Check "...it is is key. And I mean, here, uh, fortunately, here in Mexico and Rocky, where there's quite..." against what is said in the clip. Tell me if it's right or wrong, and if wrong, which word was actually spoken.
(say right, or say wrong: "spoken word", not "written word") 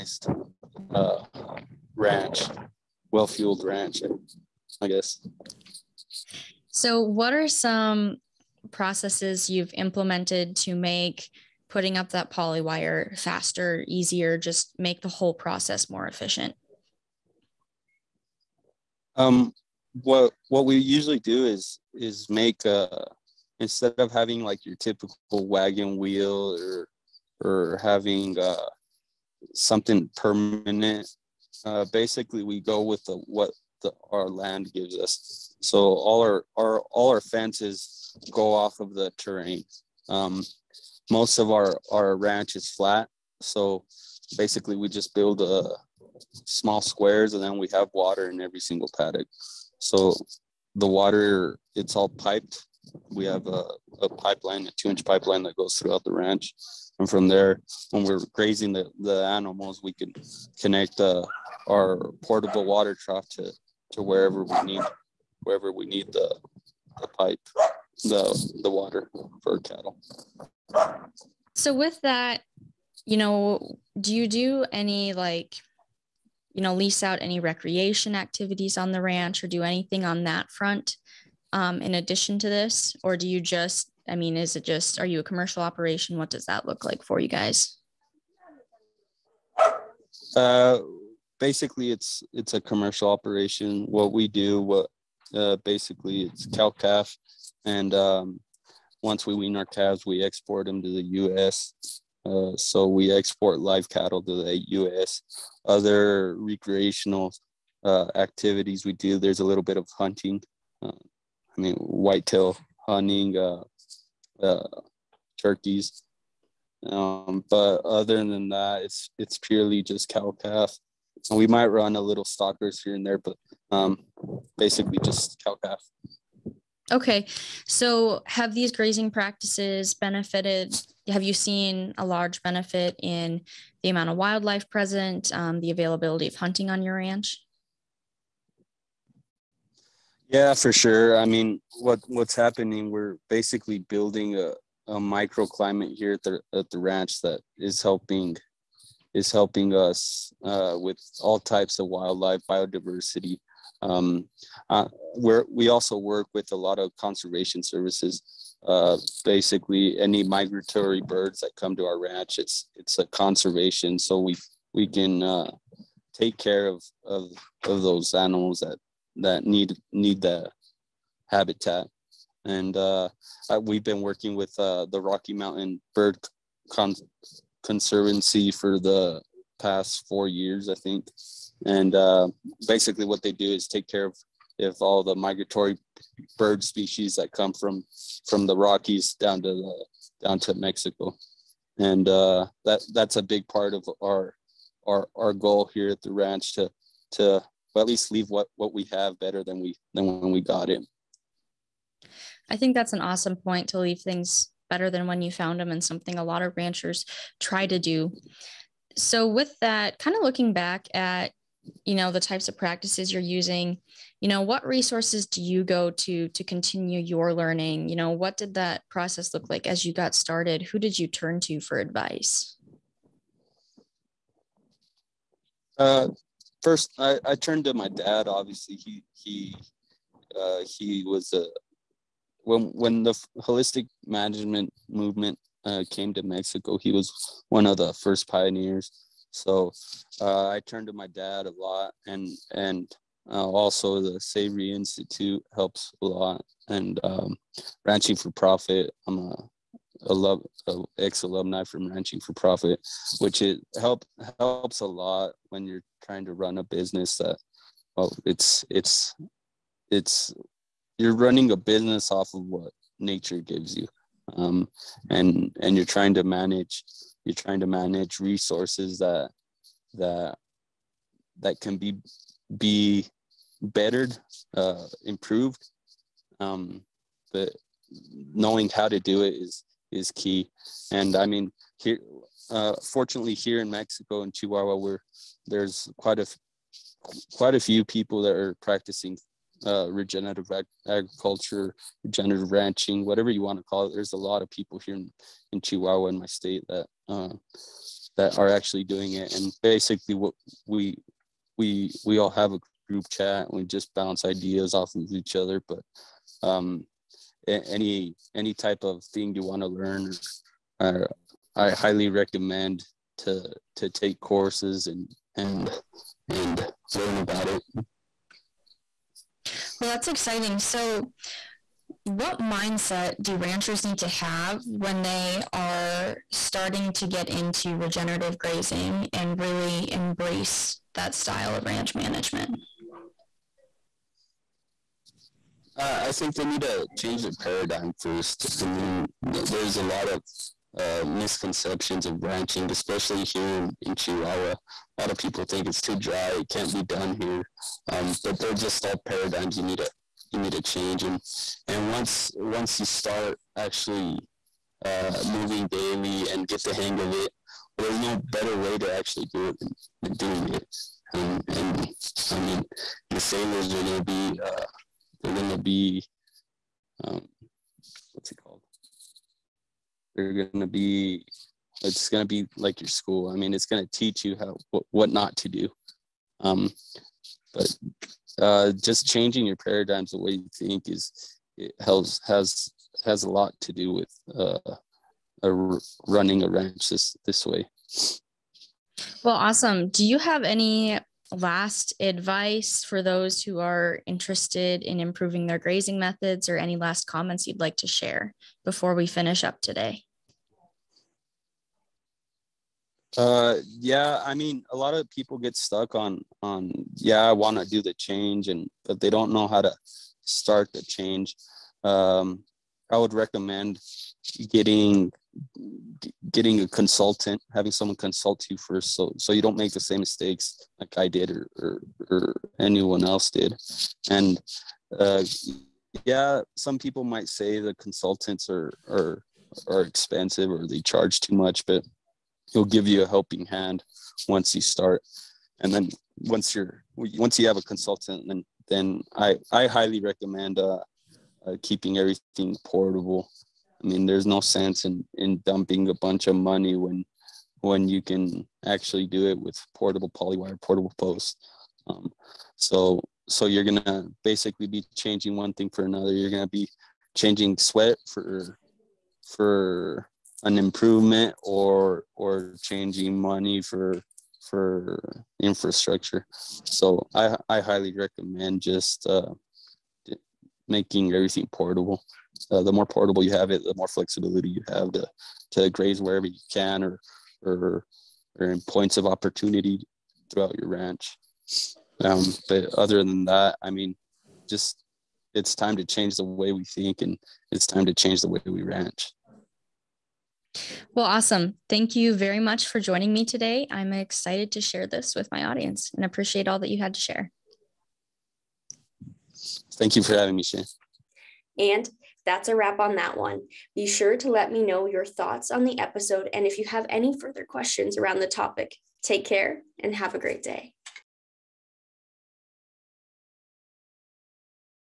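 wrong: "Chihuahua", not "Rocky".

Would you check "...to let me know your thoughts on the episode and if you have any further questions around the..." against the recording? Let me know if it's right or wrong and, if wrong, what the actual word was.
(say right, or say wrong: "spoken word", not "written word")
right.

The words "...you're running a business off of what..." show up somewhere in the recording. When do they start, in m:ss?
4:20.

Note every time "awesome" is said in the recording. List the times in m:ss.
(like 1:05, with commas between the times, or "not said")
3:22, 6:29, 8:11.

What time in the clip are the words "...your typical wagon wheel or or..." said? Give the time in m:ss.
0:24.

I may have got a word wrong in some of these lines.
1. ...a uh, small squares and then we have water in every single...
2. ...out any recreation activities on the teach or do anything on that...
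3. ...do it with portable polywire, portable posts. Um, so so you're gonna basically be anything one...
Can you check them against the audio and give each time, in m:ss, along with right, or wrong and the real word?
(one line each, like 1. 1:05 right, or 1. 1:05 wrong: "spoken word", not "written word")
1. 0:45 right
2. 1:17 wrong: "ranch", not "teach"
3. 7:29 wrong: "changing", not "anything".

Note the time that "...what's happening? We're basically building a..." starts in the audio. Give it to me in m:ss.
2:22.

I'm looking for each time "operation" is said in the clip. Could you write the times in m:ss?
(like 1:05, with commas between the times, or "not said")
1:25, 1:33.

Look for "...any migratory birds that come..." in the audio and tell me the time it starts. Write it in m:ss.
2:39.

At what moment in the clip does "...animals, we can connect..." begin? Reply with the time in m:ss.
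0:59.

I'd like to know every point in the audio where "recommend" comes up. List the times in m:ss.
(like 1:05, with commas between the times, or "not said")
5:12, 6:53, 7:19, 7:47.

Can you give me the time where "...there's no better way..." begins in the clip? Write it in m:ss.
5:57.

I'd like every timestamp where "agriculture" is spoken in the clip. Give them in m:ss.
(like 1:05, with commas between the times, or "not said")
4:50.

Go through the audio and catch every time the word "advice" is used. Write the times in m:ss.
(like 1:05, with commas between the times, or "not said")
3:41, 6:31.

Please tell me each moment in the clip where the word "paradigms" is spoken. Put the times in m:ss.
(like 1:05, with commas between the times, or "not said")
5:37, 5:48, 6:19.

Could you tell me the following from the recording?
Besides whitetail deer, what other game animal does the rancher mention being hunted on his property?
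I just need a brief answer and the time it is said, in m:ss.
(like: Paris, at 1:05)
Turkeys, at 1:55.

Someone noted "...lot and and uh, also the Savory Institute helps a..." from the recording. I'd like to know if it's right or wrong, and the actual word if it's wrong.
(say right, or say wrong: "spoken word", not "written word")
right.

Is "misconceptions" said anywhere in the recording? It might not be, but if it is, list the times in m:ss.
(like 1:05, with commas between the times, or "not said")
5:41.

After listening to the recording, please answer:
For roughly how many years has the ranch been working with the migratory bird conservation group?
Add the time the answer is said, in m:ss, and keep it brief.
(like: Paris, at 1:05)
4, at 3:00.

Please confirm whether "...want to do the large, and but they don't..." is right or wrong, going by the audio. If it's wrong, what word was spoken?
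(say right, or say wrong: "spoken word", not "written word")
wrong: "change", not "large".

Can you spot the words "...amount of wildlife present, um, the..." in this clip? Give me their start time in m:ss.
2:13.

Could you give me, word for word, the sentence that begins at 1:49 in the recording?
There's a little bit of hunting.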